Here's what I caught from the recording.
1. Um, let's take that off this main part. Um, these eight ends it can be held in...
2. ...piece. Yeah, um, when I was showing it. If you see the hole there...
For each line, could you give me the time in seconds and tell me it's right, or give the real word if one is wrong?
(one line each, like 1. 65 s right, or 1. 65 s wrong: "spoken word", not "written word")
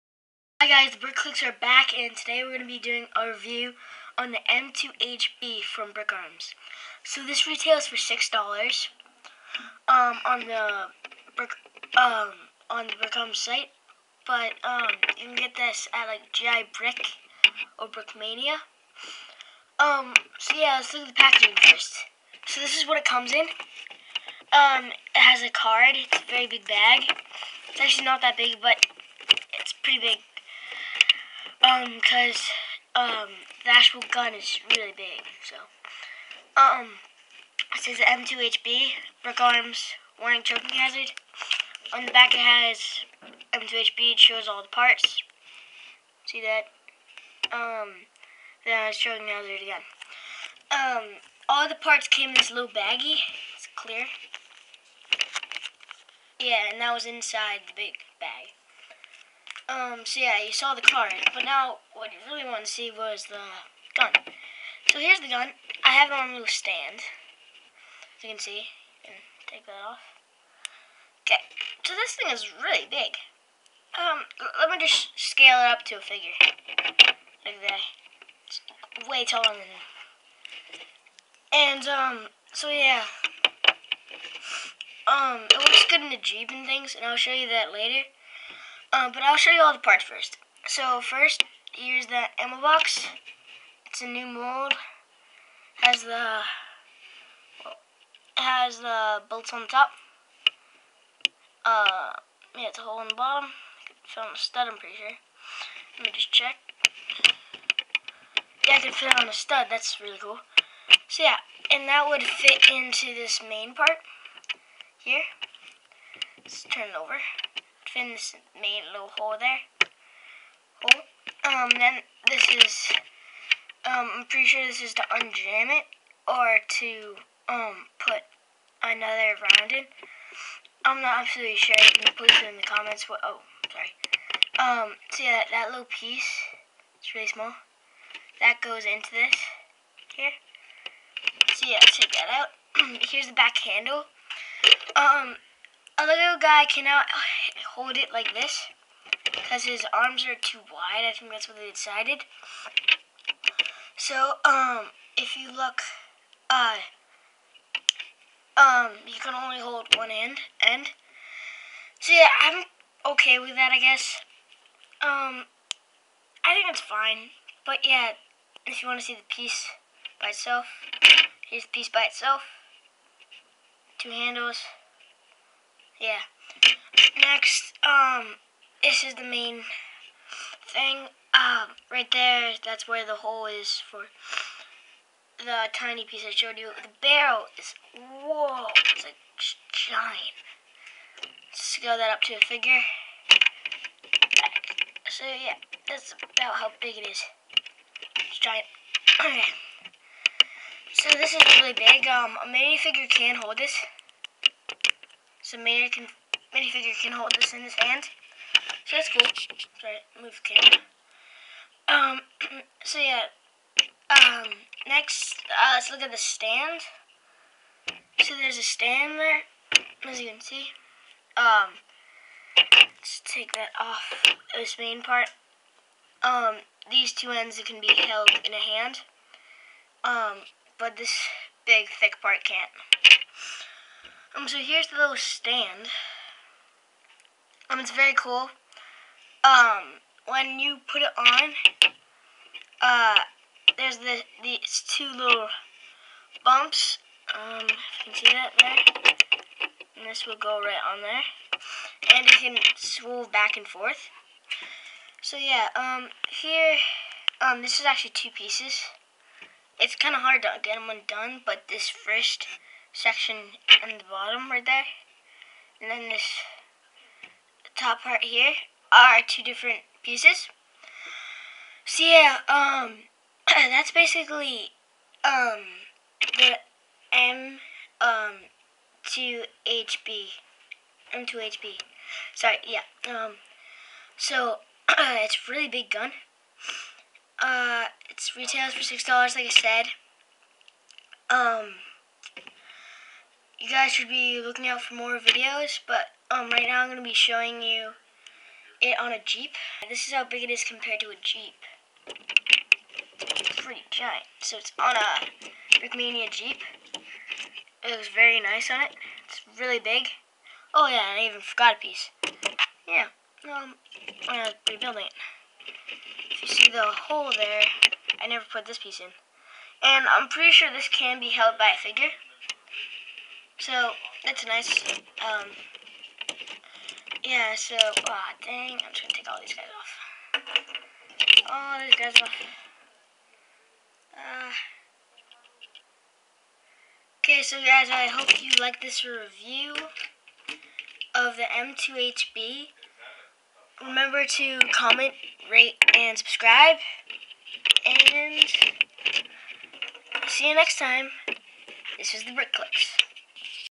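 1. 221 s wrong: "two", not "eight"
2. 311 s wrong: "rebuilding", not "showing".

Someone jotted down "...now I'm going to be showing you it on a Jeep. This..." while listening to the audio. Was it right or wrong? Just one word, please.
right.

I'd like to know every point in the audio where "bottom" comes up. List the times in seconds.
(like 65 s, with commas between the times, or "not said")
103 s, 264 s.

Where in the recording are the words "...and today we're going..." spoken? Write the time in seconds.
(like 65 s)
1 s.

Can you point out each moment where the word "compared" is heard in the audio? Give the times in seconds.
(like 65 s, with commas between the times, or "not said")
300 s.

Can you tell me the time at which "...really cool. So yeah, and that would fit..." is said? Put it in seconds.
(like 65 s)
110 s.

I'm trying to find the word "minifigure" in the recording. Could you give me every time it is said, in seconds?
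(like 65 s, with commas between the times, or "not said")
202 s, 206 s.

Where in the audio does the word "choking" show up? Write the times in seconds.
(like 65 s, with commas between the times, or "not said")
40 s, 48 s.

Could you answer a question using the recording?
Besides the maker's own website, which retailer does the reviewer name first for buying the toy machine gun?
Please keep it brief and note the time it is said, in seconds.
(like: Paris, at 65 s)
GI Brick, at 16 s.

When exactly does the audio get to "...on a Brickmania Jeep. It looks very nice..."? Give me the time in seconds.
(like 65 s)
304 s.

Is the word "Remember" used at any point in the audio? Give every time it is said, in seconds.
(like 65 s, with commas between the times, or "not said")
343 s.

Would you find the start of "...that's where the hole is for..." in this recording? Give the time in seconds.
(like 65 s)
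182 s.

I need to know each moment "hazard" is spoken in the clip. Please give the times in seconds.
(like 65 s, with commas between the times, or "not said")
40 s, 49 s.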